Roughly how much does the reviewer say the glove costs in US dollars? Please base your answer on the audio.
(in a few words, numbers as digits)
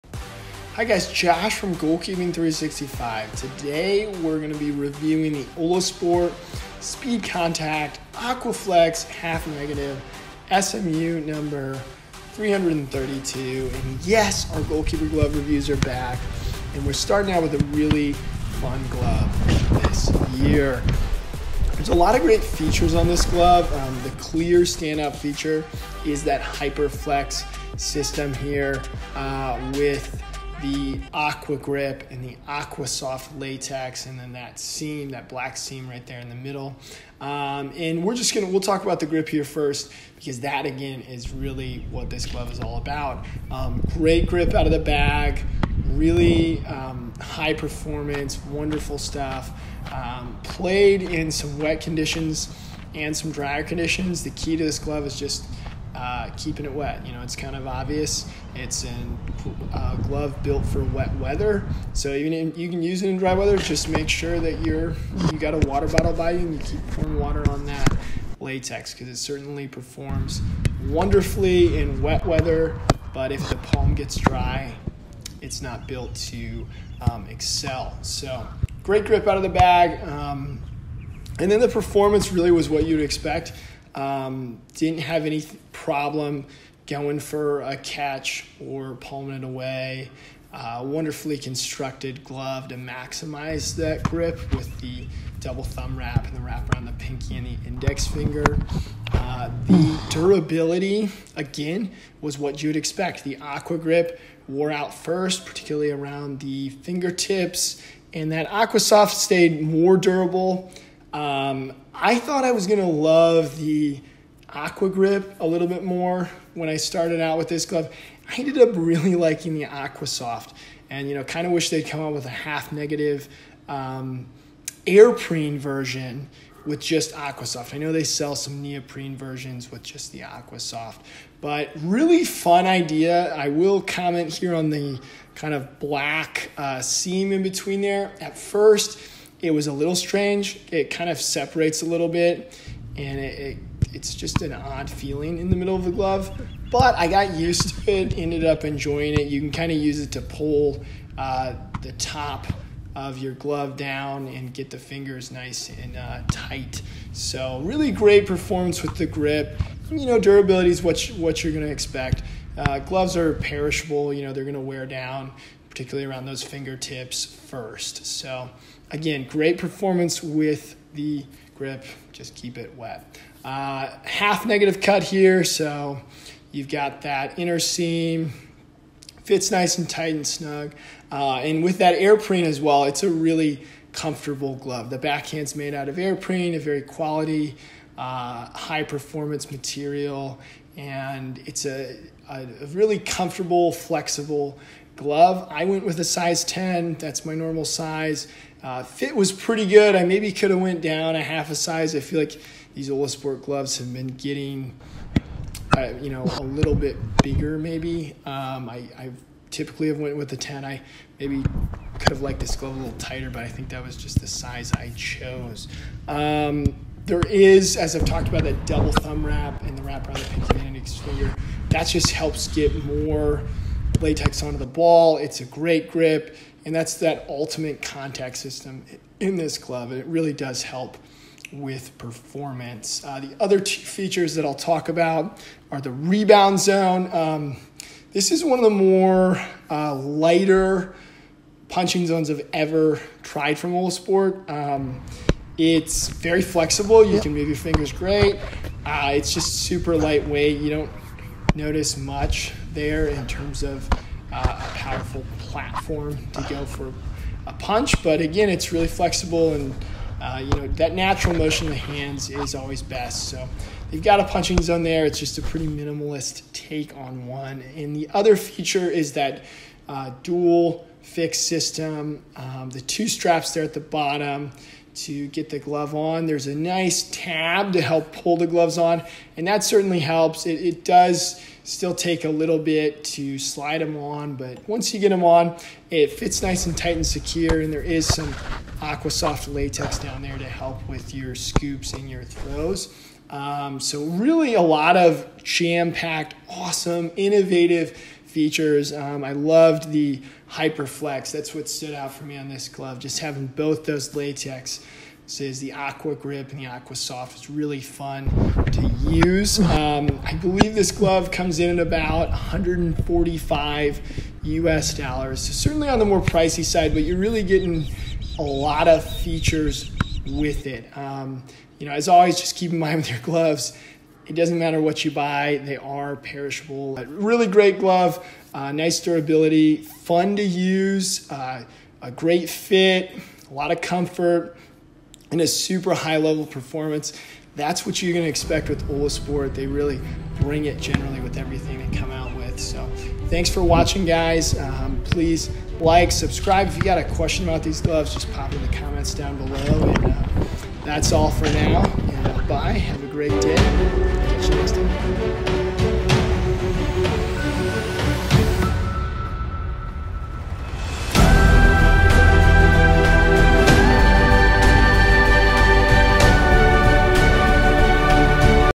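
145.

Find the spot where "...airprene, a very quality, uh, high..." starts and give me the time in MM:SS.
03:05.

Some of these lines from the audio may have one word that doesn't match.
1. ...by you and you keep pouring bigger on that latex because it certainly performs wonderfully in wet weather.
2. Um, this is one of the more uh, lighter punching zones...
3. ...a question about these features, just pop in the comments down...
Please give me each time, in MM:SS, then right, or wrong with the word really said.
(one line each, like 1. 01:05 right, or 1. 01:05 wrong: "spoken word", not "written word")
1. 01:06 wrong: "water", not "bigger"
2. 03:57 right
3. 05:46 wrong: "gloves", not "features".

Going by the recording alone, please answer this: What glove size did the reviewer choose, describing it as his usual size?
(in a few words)
10.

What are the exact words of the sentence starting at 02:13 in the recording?
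I will comment here on the kind of black uh, seam in between there.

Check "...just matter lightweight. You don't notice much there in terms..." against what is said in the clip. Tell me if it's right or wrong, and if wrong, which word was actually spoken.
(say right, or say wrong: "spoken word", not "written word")
wrong: "super", not "matter".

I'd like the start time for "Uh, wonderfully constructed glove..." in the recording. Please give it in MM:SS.
01:30.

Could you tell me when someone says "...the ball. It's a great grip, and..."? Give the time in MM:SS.
03:44.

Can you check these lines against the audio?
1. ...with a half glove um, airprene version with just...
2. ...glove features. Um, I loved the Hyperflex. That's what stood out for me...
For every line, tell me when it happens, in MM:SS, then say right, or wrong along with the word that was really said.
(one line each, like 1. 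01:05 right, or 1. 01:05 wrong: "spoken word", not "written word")
1. 02:02 wrong: "negative", not "glove"
2. 04:57 wrong: "innovative", not "glove".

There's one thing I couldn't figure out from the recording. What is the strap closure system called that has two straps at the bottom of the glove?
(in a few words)
Dual fixed system.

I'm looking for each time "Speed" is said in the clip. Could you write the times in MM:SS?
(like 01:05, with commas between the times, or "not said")
00:06.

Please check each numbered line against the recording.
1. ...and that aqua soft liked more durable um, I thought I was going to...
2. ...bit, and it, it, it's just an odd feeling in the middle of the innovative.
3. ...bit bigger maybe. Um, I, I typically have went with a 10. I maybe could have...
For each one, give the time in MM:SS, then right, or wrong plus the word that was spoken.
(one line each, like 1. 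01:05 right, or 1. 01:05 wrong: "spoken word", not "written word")
1. 01:48 wrong: "stayed", not "liked"
2. 02:22 wrong: "glove", not "innovative"
3. 03:26 right.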